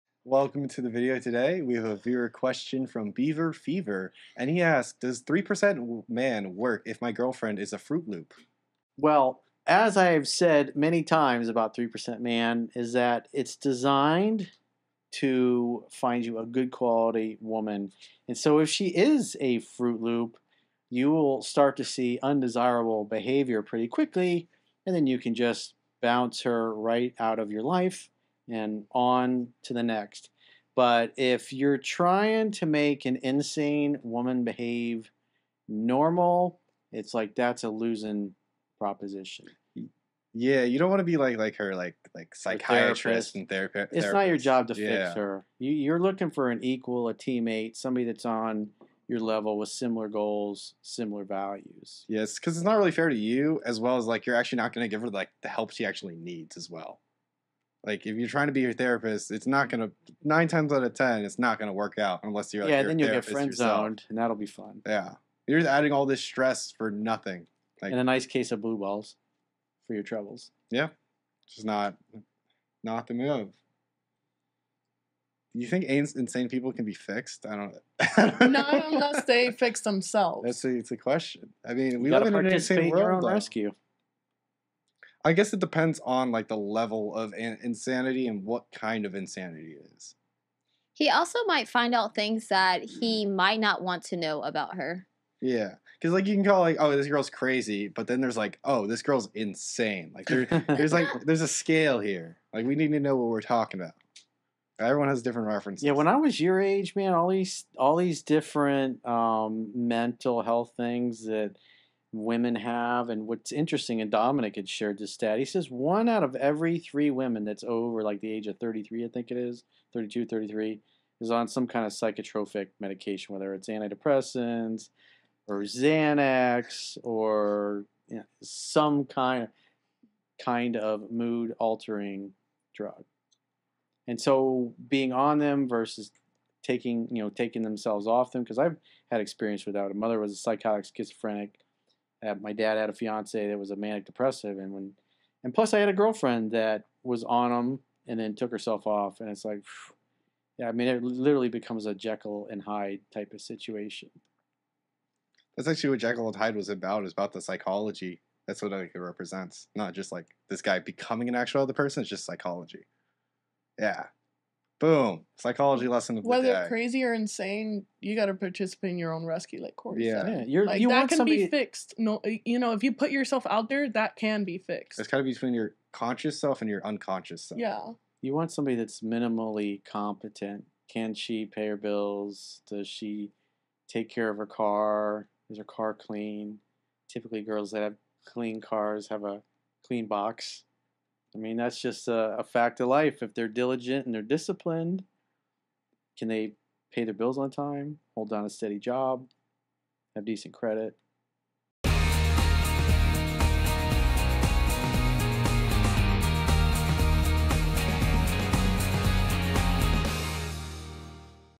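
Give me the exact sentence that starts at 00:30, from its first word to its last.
But if you're trying to make an insane woman behave normal, it's like that's a losing proposition.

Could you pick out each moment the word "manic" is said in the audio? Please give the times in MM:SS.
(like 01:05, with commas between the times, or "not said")
02:23.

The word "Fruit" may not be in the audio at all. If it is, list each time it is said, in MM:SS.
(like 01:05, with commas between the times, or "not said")
00:07, 00:19.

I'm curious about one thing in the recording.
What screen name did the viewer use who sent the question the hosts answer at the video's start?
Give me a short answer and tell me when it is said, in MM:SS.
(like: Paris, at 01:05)
Beaver Fever, at 00:03.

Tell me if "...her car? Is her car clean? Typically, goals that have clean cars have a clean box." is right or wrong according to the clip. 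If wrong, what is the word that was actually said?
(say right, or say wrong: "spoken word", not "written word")
wrong: "girls", not "goals".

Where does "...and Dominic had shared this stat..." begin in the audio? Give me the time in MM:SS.
01:54.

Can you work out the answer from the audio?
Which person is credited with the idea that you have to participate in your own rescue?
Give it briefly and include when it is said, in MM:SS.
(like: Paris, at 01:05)
Corey, at 02:49.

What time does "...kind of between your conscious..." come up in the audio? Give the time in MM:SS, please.
02:55.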